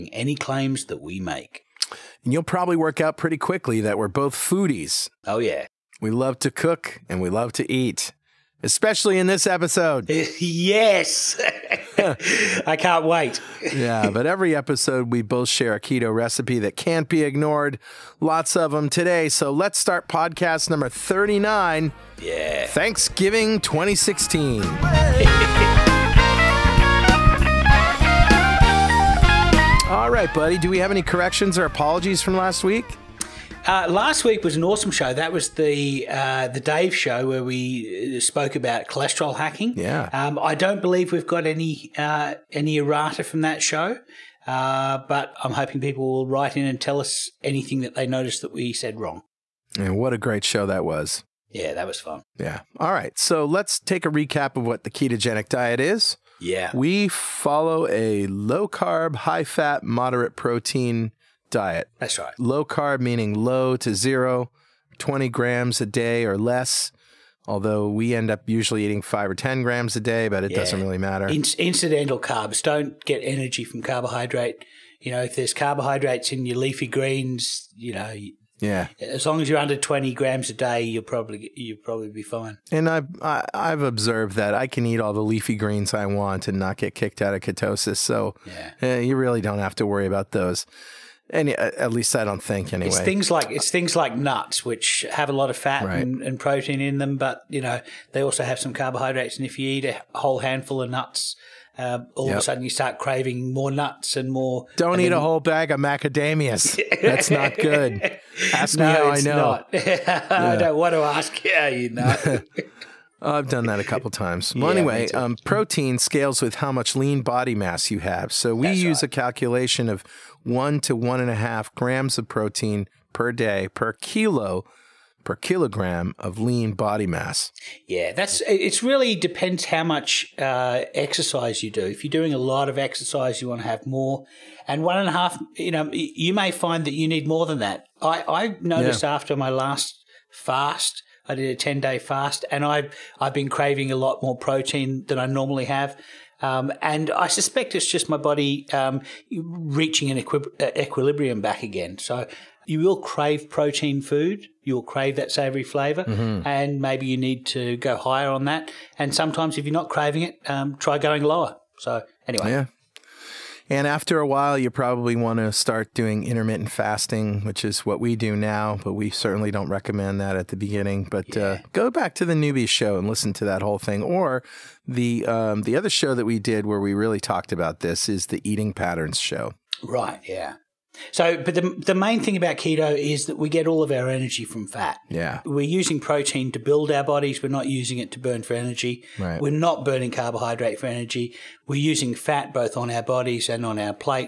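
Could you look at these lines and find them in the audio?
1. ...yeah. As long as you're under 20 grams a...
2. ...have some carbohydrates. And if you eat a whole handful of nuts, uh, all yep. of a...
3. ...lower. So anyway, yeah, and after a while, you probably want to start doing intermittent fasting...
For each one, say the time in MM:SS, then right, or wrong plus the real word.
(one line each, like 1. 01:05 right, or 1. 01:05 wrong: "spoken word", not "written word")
1. 01:18 right
2. 01:38 right
3. 02:41 right.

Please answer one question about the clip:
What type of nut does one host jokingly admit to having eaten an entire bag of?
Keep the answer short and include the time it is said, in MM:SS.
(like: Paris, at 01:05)
macadamias, at 01:45.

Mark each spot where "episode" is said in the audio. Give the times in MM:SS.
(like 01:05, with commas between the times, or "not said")
00:09, 00:14.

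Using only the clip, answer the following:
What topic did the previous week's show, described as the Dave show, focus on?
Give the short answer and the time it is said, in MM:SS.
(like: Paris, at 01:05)
cholesterol hacking, at 00:38.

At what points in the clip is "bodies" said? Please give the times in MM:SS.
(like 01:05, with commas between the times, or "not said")
03:07, 03:13.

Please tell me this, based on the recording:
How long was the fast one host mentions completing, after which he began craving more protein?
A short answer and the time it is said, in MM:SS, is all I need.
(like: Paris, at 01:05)
10 days, at 02:21.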